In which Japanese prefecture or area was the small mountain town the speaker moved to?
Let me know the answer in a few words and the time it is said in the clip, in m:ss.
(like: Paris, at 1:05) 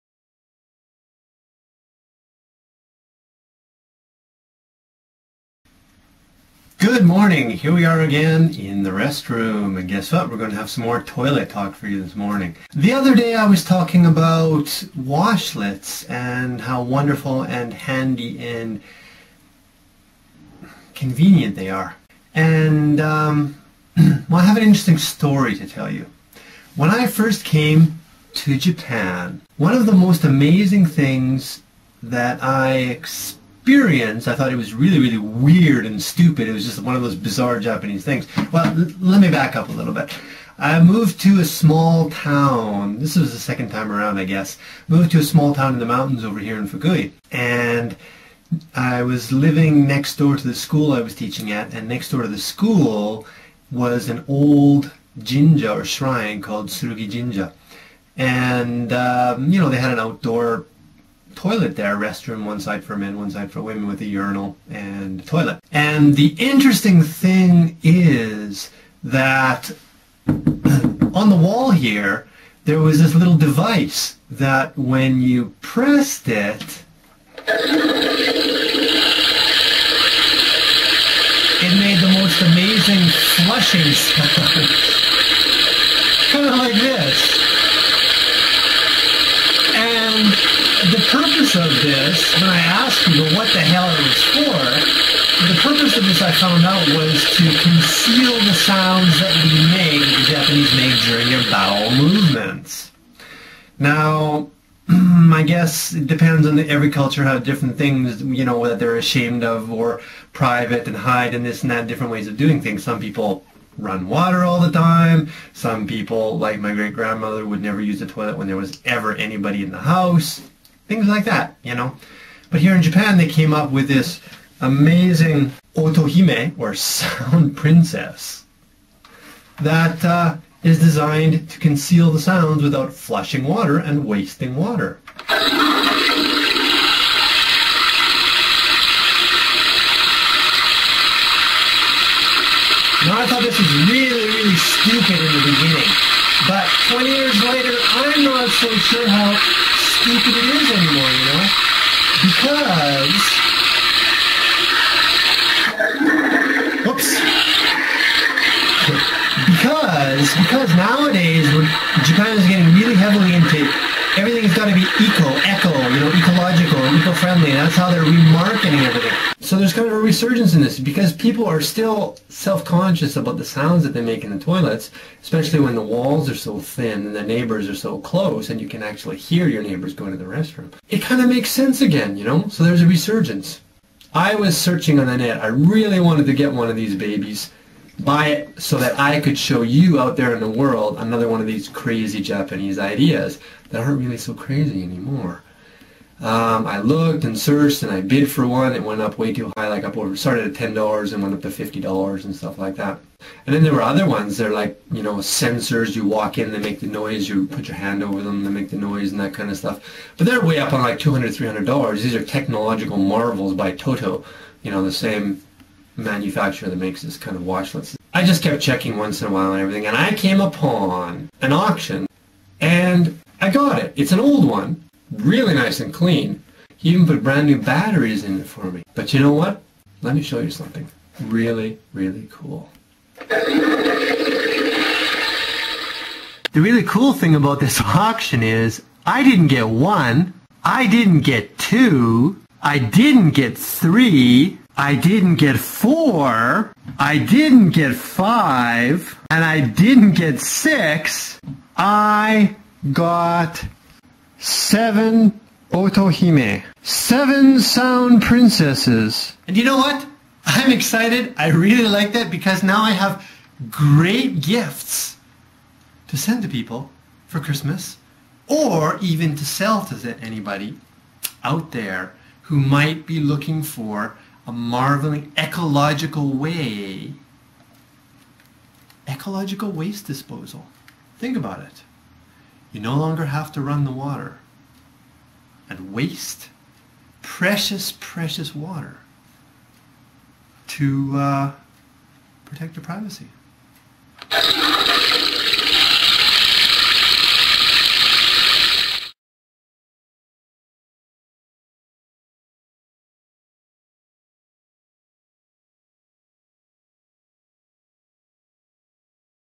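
Fukui, at 0:46.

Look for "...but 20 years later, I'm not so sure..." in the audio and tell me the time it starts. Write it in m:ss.
2:26.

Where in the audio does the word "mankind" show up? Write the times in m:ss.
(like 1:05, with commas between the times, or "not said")
not said.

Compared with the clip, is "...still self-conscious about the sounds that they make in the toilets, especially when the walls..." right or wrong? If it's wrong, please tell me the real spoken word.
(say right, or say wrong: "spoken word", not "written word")
right.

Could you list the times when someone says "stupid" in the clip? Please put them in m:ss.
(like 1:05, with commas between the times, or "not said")
0:36, 2:24, 2:30.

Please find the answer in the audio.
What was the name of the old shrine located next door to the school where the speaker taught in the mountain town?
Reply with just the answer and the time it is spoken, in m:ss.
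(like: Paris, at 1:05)
Tsurugi Jinja, at 0:56.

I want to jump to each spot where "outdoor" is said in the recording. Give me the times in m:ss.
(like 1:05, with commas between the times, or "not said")
0:59.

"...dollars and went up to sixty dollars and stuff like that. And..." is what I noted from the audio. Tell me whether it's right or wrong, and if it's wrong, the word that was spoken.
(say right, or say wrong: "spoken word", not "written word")
wrong: "fifty", not "sixty".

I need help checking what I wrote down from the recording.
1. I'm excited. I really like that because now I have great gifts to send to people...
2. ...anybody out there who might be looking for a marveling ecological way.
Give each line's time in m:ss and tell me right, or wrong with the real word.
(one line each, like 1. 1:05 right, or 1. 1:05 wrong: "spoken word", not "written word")
1. 4:20 right
2. 4:30 right.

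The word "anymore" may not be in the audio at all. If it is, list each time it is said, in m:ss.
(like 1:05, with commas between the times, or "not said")
2:30, 3:14.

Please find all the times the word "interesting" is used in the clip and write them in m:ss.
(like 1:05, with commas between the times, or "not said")
0:24, 1:06.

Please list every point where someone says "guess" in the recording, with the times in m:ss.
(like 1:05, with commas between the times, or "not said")
0:09, 0:44, 1:45.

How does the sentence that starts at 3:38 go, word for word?
I just kept checking once in a while and everything, and I came upon an auction, and I got it.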